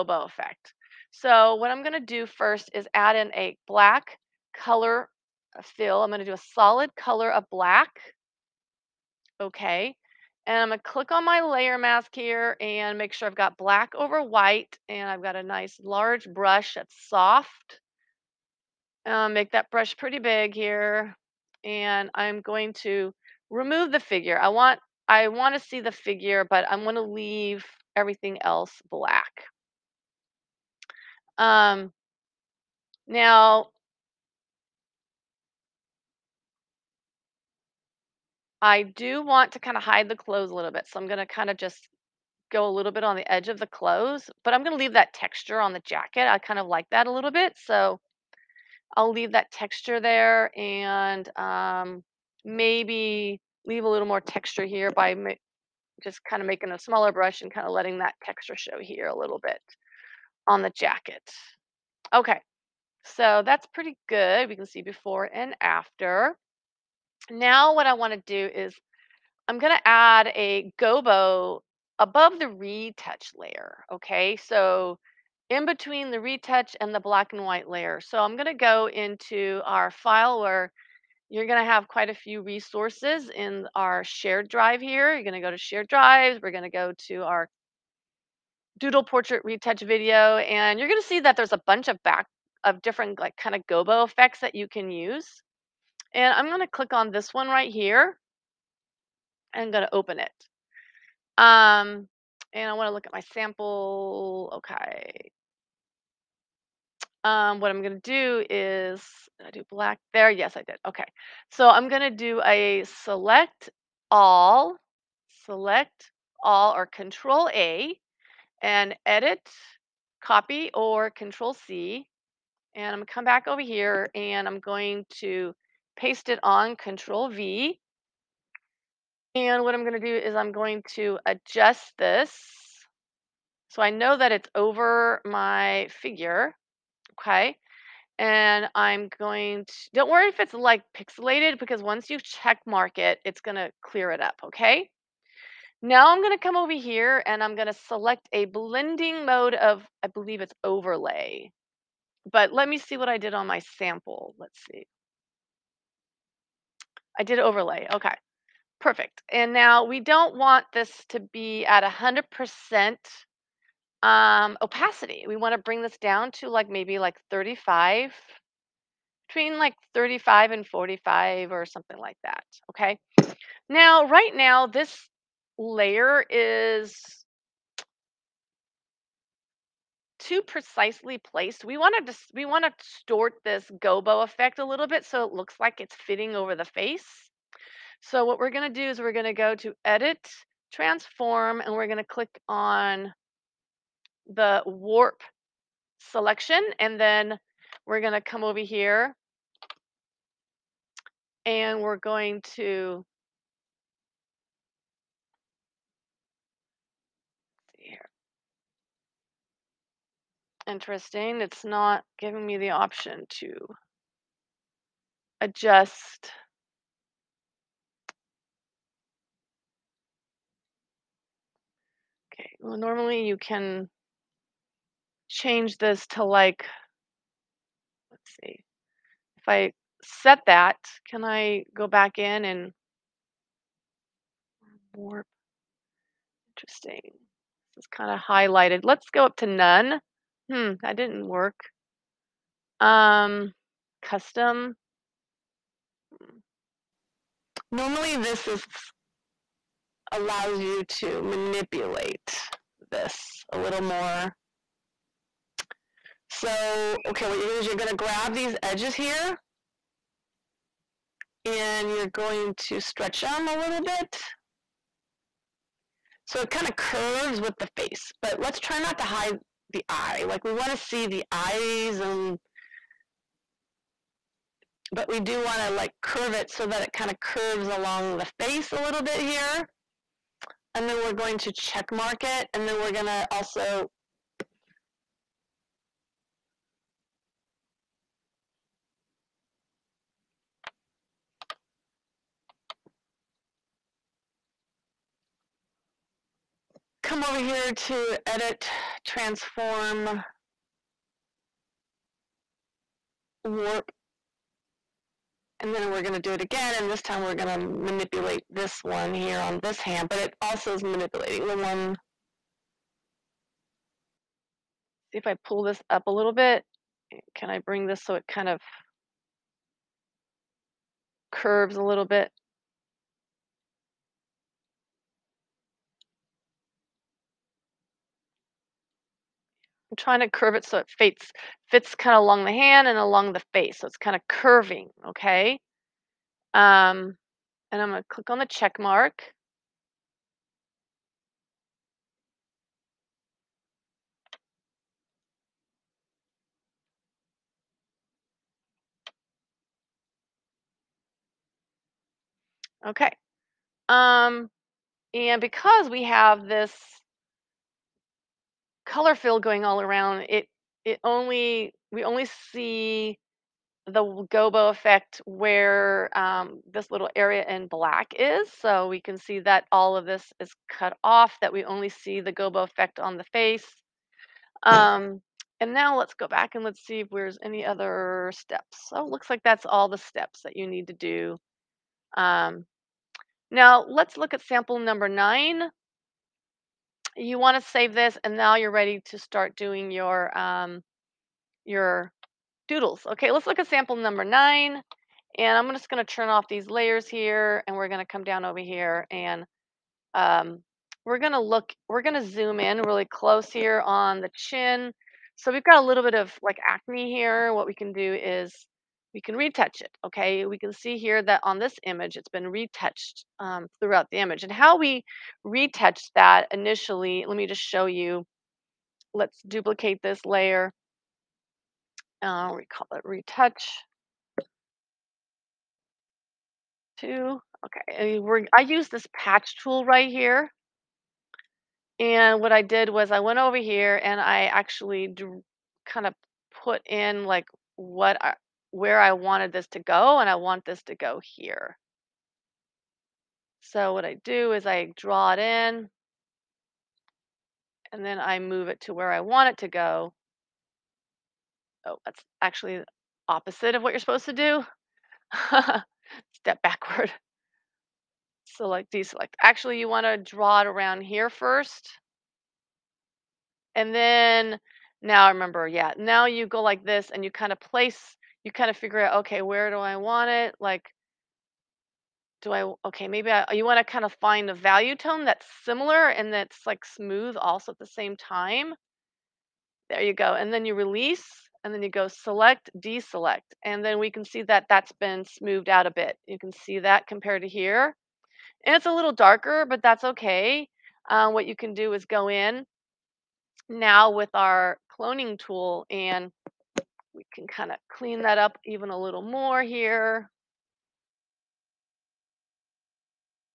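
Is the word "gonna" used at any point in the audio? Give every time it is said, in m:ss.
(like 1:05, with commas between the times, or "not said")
2:02, 2:09, 2:23.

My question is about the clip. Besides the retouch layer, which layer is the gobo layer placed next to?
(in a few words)
black and white layer.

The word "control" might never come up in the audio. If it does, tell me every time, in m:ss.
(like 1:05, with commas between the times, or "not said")
1:56, 2:01, 2:06.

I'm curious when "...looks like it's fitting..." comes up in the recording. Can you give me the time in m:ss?
3:05.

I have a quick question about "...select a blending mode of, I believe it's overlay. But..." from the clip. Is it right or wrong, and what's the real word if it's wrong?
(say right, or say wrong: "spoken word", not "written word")
right.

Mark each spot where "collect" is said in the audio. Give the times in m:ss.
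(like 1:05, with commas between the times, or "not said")
not said.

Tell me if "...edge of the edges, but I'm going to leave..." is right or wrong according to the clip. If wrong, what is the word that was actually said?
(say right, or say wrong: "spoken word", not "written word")
wrong: "clothes", not "edges".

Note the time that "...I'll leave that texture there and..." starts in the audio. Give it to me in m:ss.
0:48.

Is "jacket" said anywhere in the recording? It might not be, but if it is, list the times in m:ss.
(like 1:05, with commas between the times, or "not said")
0:45, 1:00.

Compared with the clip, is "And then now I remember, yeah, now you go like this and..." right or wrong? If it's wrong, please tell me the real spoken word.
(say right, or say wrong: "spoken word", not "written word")
right.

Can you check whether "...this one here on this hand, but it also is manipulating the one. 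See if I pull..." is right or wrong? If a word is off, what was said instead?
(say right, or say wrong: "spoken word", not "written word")
right.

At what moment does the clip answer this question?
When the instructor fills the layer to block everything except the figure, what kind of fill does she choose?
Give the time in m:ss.
0:06.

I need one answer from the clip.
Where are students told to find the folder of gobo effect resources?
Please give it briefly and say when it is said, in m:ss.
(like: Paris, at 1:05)
shared drives, at 1:25.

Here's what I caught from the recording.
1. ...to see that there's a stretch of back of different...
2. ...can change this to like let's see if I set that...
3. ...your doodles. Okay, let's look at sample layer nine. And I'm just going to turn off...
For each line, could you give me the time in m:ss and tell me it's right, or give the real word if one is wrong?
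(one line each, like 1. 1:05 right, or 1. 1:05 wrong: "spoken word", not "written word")
1. 1:31 wrong: "bunch", not "stretch"
2. 3:43 right
3. 6:31 wrong: "number", not "layer".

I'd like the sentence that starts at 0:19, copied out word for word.
Uh, make that brush pretty big here.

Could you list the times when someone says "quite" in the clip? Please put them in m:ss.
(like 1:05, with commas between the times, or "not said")
1:21.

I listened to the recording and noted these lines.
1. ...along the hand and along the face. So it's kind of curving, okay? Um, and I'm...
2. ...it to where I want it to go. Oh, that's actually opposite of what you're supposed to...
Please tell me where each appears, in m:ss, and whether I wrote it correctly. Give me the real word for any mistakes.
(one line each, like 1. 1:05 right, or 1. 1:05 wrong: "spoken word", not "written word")
1. 5:32 right
2. 7:28 right.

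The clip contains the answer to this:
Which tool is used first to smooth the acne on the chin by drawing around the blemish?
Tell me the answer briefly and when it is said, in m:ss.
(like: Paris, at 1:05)
patch tool, at 7:09.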